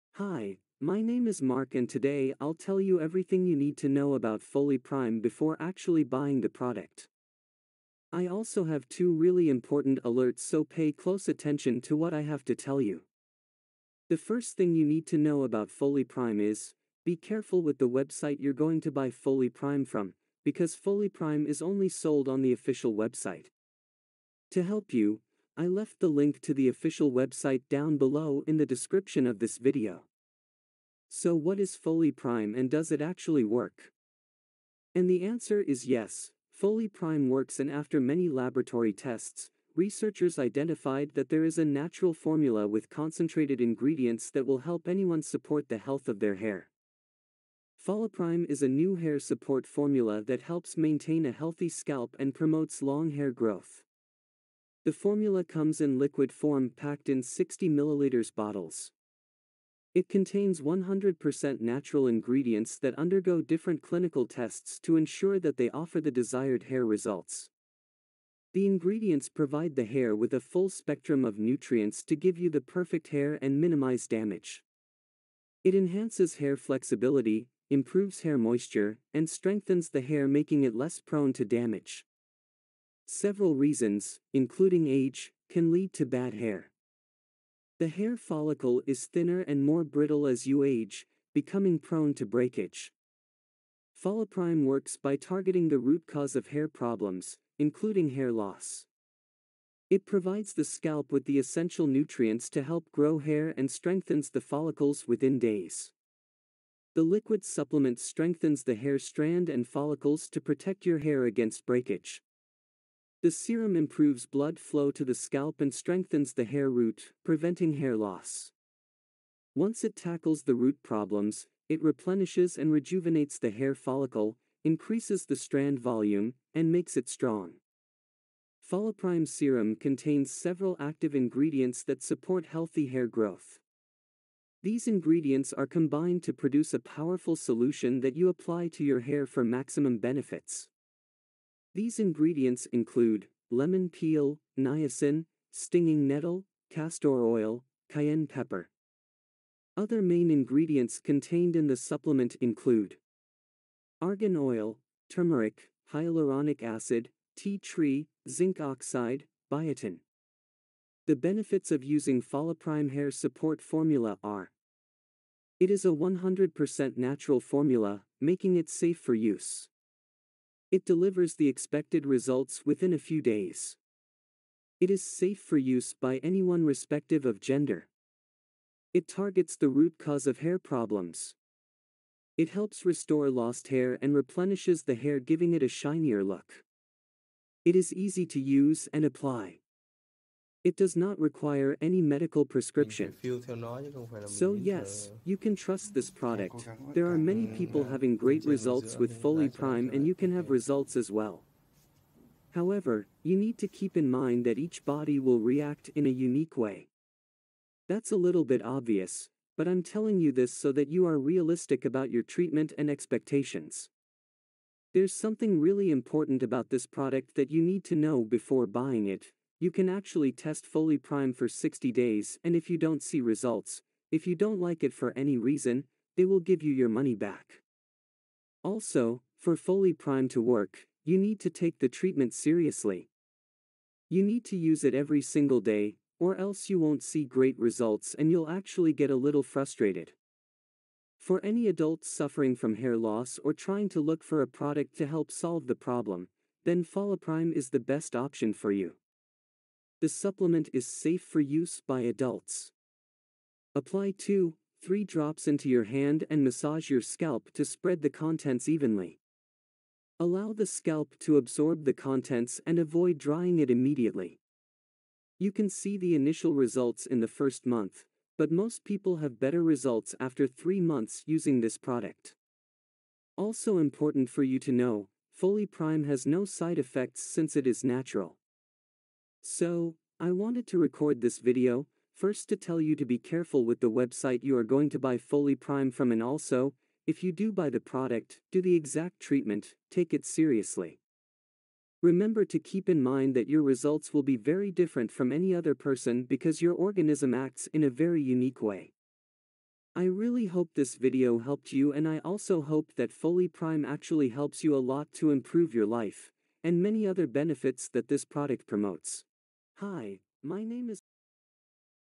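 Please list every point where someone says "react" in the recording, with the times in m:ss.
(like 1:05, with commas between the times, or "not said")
3:25.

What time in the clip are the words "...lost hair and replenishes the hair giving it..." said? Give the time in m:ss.
3:03.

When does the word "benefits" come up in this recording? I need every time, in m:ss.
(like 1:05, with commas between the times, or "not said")
2:19, 2:41, 5:07.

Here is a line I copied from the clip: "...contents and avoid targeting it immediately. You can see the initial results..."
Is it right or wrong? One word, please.
wrong.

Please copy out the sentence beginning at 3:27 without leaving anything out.
That's a little bit obvious, but I'm telling you this so that you are realistic about your treatment and expectations.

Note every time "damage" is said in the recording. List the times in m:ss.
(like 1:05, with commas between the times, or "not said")
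1:14, 1:21.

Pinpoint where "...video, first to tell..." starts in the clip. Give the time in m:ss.
4:41.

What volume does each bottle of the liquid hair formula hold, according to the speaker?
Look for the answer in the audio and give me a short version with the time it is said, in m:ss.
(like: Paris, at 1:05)
60 milliliters, at 0:57.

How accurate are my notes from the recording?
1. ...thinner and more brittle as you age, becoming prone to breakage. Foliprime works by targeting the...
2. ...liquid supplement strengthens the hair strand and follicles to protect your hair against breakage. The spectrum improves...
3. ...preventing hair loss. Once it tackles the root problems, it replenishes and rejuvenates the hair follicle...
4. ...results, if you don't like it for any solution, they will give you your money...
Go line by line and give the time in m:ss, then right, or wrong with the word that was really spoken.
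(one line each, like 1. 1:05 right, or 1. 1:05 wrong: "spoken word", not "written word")
1. 1:29 right
2. 1:47 wrong: "serum", not "spectrum"
3. 1:57 right
4. 3:43 wrong: "reason", not "solution".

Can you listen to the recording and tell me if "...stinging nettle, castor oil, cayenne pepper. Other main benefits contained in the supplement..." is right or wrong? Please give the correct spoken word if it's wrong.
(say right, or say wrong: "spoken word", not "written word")
wrong: "ingredients", not "benefits".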